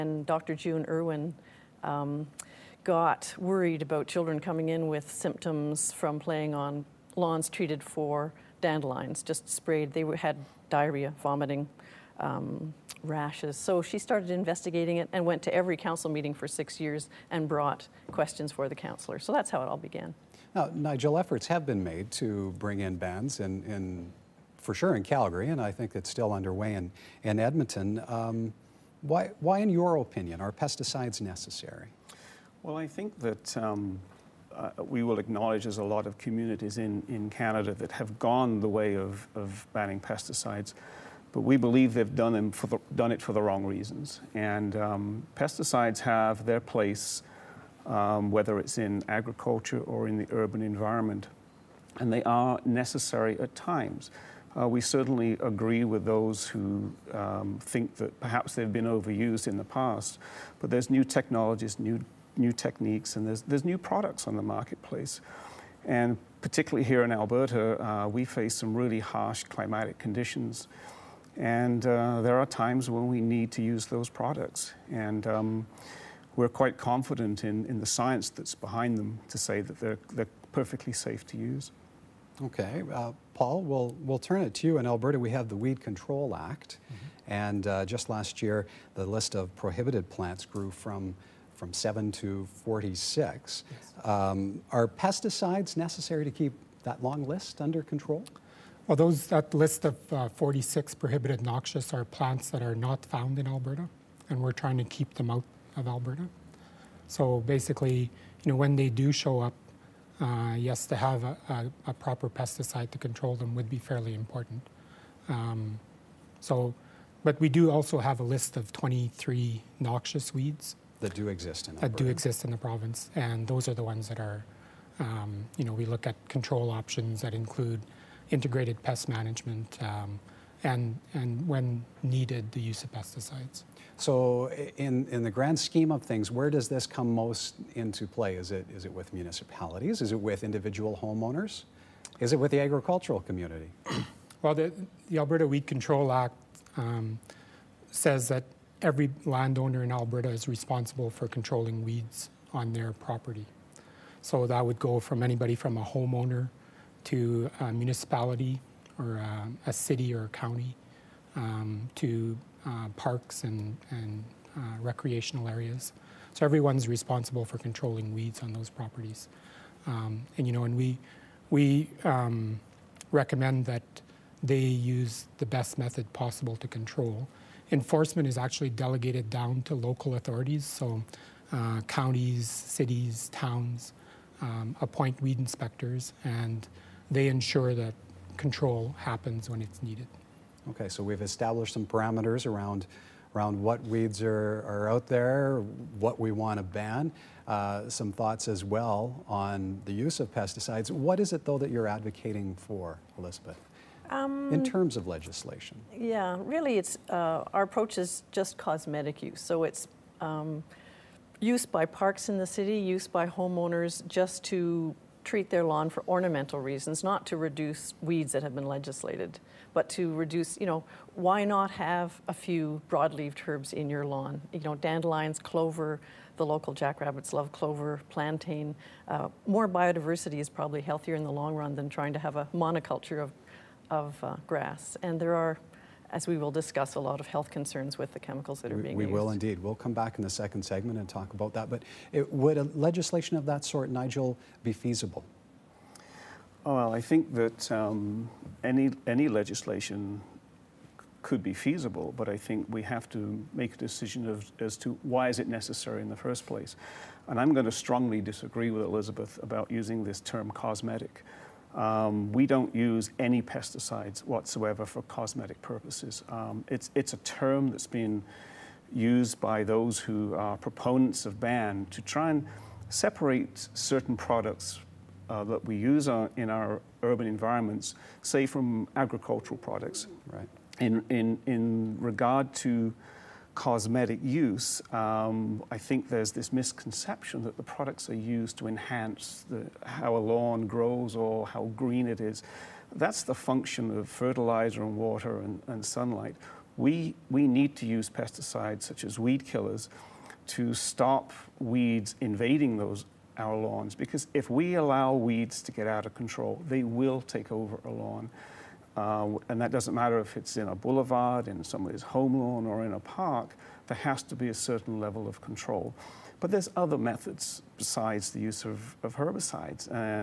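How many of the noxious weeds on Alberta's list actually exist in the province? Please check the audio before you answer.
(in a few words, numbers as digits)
23.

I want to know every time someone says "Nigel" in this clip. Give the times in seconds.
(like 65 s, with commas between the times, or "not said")
20 s, 243 s.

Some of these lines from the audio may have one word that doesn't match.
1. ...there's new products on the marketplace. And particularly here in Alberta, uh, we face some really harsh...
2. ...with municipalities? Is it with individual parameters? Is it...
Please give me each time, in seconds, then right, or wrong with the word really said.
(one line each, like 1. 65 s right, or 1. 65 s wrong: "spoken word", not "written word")
1. 63 s right
2. 138 s wrong: "homeowners", not "parameters".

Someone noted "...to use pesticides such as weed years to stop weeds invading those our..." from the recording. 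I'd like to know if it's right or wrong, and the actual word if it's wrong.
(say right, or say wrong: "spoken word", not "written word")
wrong: "killers", not "years".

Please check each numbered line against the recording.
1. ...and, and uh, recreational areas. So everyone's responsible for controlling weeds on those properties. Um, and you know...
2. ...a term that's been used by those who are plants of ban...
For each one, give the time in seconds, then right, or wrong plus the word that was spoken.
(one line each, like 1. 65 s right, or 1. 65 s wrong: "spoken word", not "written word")
1. 163 s right
2. 267 s wrong: "proponents", not "plants".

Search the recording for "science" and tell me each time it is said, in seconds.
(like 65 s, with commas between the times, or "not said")
77 s.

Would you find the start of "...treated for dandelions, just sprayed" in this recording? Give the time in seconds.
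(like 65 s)
7 s.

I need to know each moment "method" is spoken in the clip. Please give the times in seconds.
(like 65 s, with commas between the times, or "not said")
175 s, 316 s.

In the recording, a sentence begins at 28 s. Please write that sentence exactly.
Um, why, why, in your opinion, are pesticides necessary?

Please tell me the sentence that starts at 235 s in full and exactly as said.
And there are as we will discuss a lot of health concerns with the chemicals that are we, being we used.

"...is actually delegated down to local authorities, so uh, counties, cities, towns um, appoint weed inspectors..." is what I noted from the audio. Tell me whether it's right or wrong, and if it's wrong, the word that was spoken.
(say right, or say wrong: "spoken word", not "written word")
right.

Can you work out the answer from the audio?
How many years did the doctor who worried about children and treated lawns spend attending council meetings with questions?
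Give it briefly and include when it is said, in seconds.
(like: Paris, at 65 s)
6, at 16 s.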